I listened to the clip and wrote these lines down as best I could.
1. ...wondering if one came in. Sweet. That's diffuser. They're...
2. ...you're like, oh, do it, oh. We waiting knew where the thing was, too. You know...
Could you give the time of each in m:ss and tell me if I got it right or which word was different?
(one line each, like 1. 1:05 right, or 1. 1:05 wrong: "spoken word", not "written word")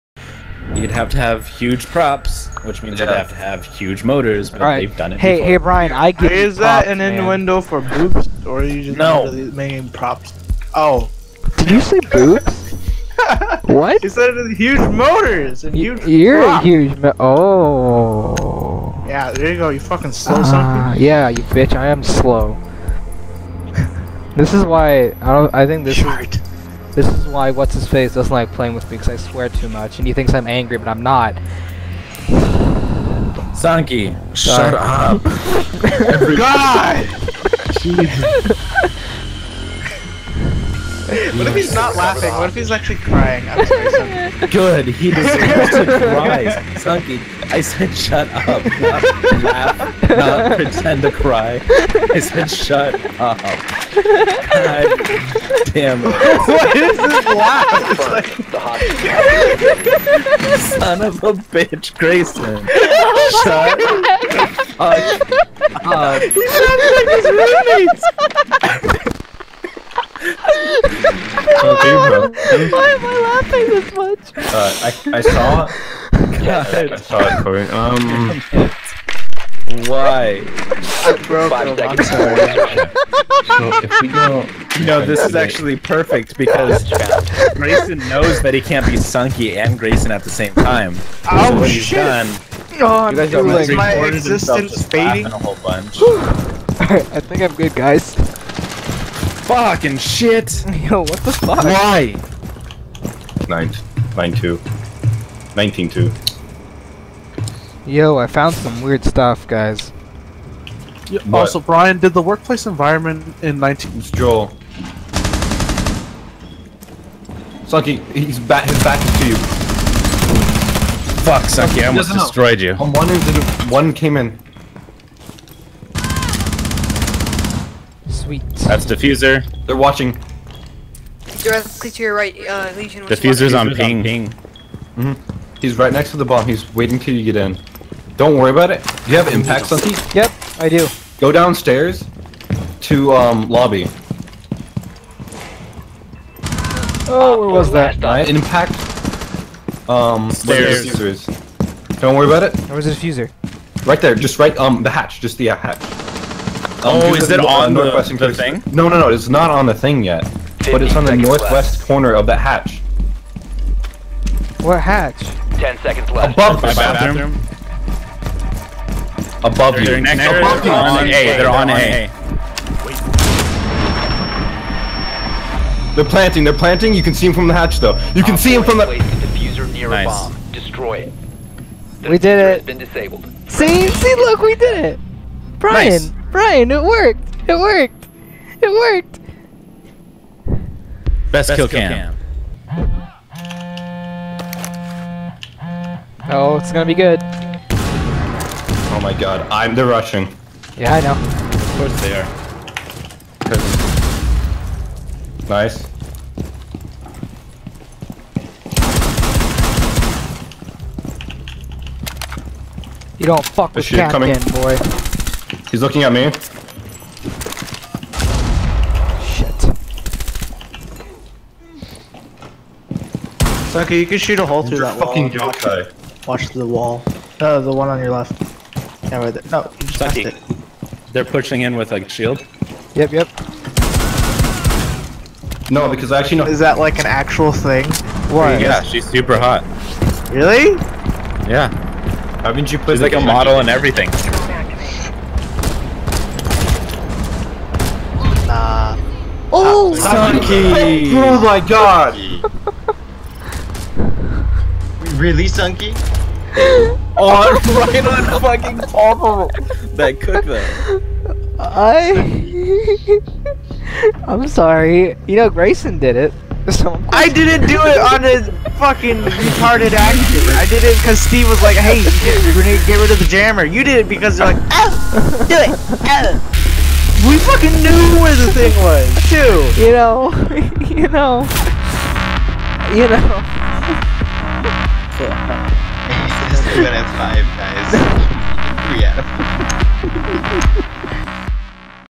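1. 2:02 right
2. 4:34 wrong: "fucking", not "waiting".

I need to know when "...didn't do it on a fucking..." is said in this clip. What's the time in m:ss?
4:27.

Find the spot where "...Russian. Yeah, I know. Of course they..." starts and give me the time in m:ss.
3:19.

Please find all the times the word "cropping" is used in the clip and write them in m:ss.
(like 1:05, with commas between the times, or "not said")
not said.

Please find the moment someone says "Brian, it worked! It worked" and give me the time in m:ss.
3:06.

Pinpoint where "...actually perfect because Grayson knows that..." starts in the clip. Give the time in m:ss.
1:25.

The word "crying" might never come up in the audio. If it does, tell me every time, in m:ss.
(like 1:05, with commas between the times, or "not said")
0:42.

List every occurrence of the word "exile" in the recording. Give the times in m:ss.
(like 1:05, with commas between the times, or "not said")
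not said.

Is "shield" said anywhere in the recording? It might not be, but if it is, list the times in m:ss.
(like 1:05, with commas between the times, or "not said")
3:52.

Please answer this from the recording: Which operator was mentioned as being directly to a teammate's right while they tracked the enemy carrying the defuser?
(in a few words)
Lesion.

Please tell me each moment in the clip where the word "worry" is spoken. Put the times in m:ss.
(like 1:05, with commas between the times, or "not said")
2:18, 2:32.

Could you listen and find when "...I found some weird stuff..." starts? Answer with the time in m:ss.
1:48.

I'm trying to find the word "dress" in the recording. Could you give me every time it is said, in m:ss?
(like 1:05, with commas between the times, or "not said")
not said.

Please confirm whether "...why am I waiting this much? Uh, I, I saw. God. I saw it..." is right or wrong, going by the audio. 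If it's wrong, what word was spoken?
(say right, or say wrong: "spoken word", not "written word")
wrong: "laughing", not "waiting".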